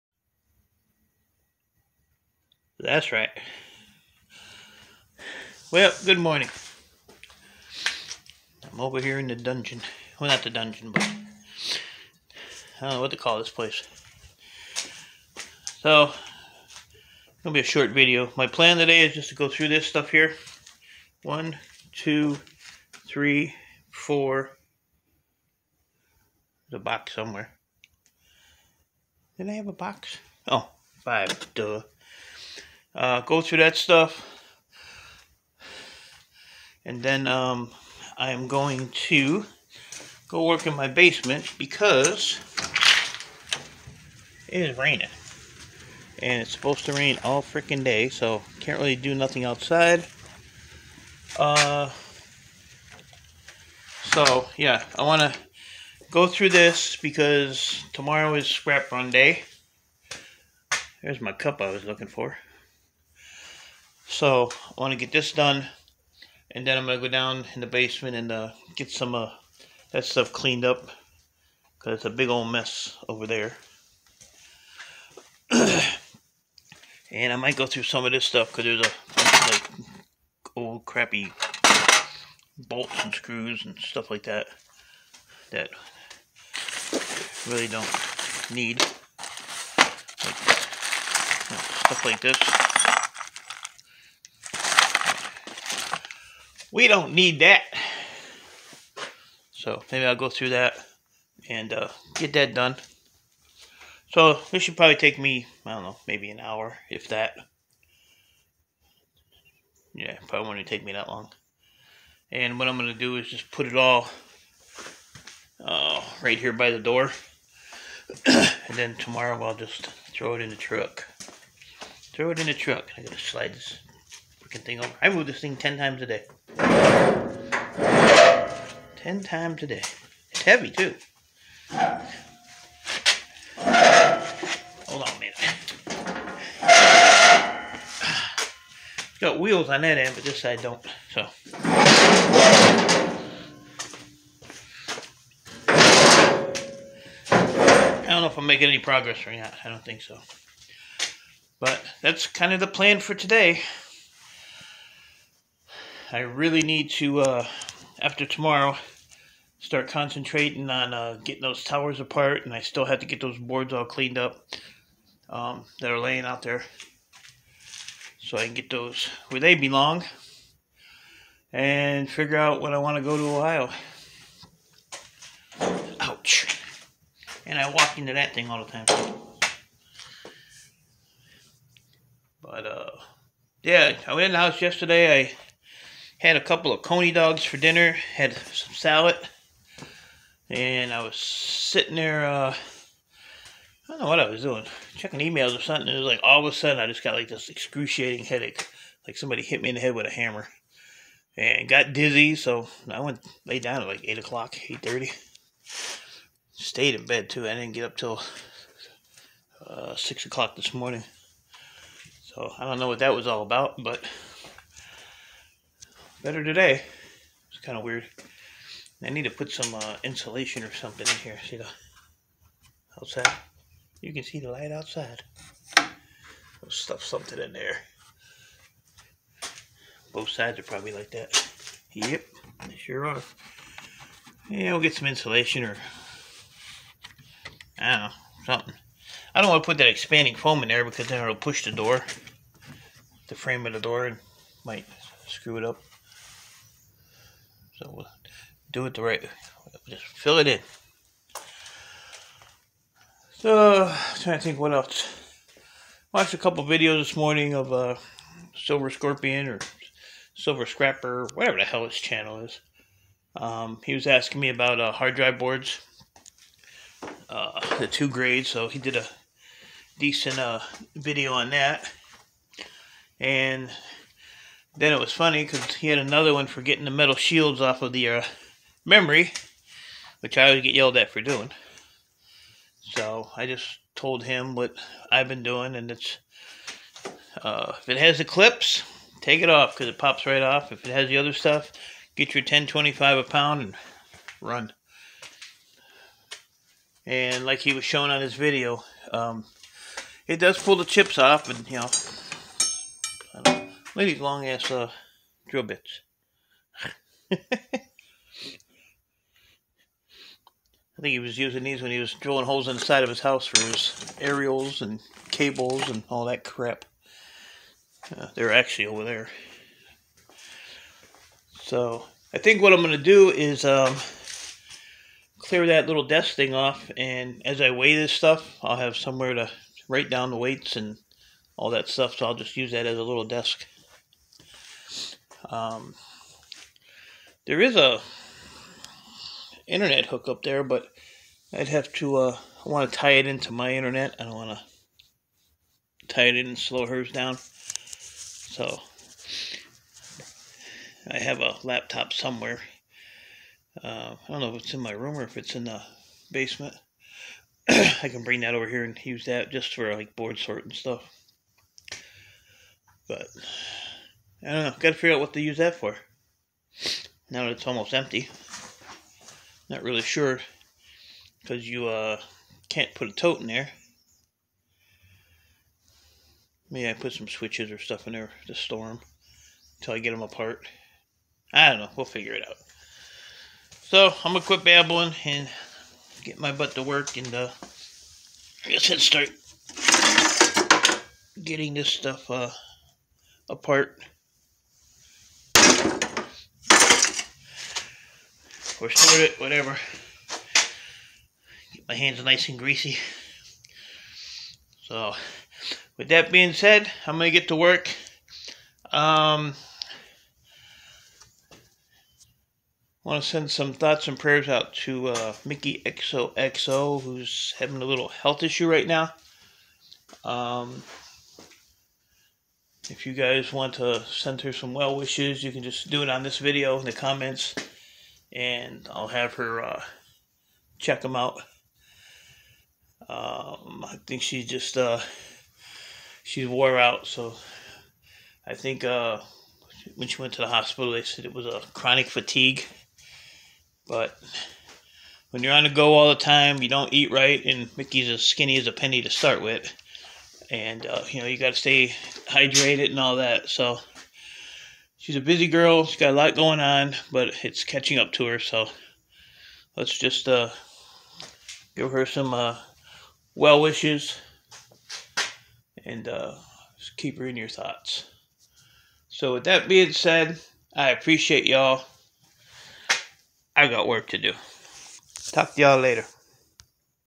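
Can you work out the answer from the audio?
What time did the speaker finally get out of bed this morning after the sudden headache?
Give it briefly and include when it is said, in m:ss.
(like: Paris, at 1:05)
6 o'clock, at 3:29.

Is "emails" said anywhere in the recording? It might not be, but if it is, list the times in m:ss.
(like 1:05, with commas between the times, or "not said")
3:15.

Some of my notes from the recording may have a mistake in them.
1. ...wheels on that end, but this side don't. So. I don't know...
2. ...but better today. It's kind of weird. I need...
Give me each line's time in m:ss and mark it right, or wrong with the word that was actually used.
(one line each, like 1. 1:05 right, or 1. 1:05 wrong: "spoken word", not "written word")
1. 2:19 right
2. 3:33 right.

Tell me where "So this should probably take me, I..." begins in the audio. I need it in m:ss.
1:44.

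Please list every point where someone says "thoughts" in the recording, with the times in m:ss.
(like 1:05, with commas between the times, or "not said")
6:53, 7:47.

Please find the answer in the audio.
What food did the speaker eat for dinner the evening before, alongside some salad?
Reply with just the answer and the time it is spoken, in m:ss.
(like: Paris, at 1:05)
coney dogs, at 3:06.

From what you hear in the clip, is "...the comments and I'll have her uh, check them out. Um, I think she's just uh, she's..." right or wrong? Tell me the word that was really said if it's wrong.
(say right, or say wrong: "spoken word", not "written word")
right.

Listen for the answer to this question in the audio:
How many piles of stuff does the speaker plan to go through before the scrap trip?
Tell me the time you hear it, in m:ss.
0:31.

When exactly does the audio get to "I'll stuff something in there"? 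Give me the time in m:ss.
3:45.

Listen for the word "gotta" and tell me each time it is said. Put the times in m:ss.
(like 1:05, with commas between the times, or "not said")
2:03, 6:04.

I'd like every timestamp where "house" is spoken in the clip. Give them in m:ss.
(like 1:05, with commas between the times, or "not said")
3:04, 5:13.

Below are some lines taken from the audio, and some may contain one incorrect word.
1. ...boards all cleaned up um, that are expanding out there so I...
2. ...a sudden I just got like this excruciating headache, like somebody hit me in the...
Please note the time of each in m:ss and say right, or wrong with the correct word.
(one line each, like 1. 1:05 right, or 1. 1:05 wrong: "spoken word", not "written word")
1. 2:43 wrong: "laying", not "expanding"
2. 3:16 right.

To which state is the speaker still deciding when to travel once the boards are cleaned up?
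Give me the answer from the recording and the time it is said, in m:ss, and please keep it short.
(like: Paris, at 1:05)
Ohio, at 2:53.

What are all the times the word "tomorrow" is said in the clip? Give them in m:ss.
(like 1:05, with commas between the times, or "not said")
0:57, 1:58, 2:38.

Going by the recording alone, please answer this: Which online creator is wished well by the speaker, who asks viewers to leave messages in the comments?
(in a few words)
Mickey XOXO.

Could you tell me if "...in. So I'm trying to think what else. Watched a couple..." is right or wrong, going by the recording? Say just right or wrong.
right.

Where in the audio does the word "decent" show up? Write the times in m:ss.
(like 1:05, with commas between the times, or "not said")
4:29.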